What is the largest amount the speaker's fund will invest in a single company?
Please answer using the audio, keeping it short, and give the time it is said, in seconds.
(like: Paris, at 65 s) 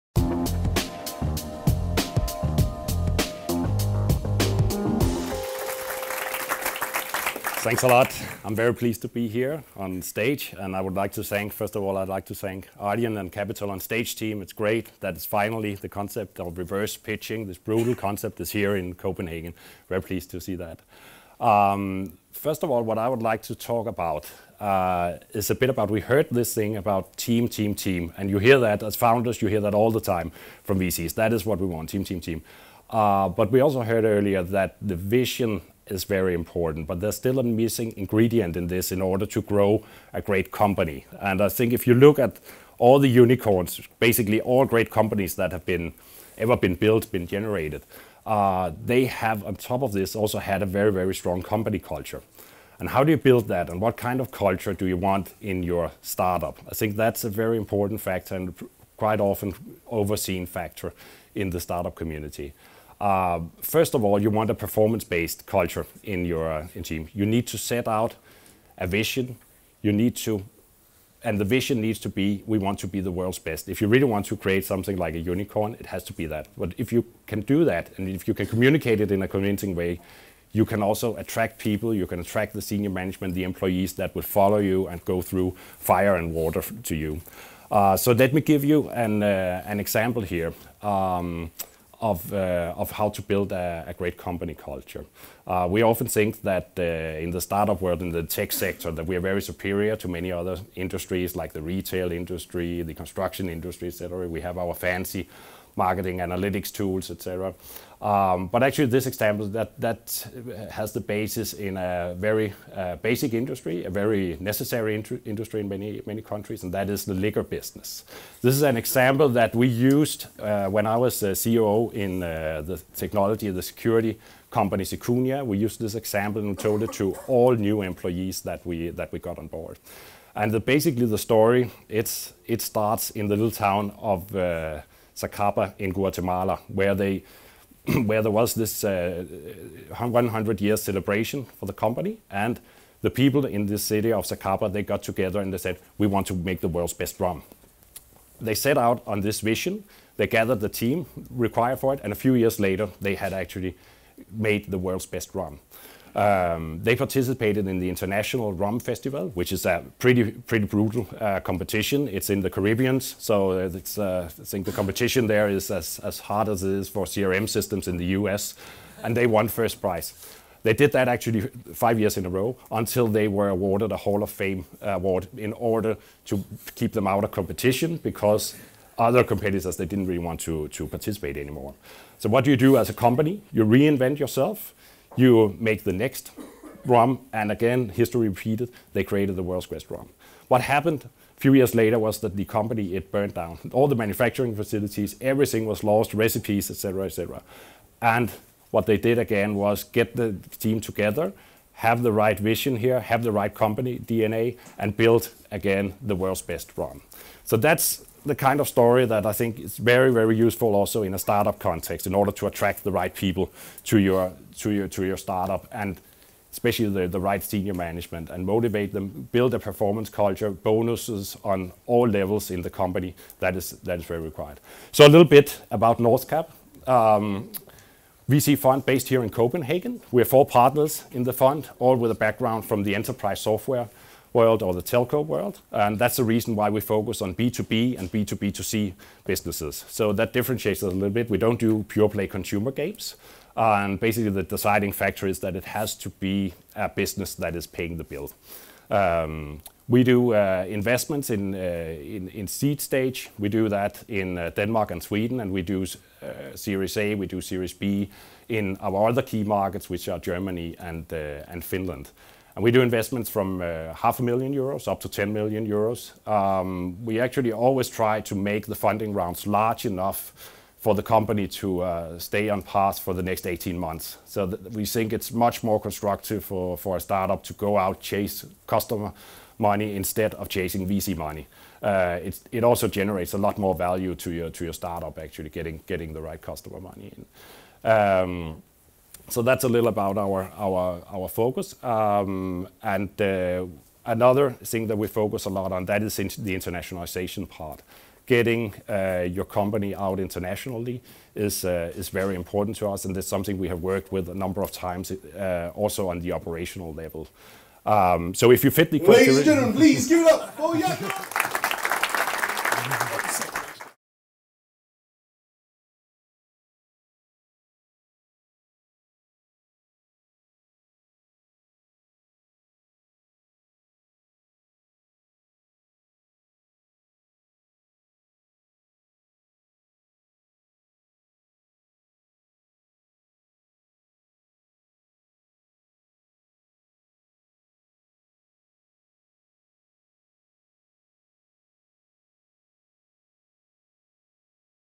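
10 million euros, at 265 s.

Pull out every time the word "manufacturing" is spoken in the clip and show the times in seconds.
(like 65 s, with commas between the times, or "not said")
193 s.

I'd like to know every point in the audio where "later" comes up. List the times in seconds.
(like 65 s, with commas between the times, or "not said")
152 s, 191 s.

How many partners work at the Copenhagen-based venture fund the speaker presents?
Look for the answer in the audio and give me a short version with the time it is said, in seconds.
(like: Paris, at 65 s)
4, at 230 s.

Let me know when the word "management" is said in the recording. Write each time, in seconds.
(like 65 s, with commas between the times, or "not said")
82 s, 217 s.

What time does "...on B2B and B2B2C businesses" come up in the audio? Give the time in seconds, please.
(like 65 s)
237 s.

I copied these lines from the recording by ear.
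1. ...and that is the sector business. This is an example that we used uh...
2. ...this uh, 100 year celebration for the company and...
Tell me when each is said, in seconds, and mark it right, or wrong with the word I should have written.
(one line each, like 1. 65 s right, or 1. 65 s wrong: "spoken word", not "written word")
1. 116 s wrong: "liquor", not "sector"
2. 138 s right.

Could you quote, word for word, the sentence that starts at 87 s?
Uh, so let me give you an, uh, an example here.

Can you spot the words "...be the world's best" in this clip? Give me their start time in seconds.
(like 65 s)
72 s.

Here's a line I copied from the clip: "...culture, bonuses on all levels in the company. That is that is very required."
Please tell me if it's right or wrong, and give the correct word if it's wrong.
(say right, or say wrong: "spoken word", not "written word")
right.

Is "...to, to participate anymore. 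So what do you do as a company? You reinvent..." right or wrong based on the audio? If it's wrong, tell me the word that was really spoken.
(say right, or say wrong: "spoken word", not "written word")
right.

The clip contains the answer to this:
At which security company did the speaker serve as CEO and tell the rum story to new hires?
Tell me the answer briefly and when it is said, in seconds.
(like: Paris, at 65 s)
Secunia, at 124 s.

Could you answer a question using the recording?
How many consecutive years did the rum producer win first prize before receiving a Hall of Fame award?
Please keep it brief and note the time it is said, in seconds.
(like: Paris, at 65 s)
5, at 171 s.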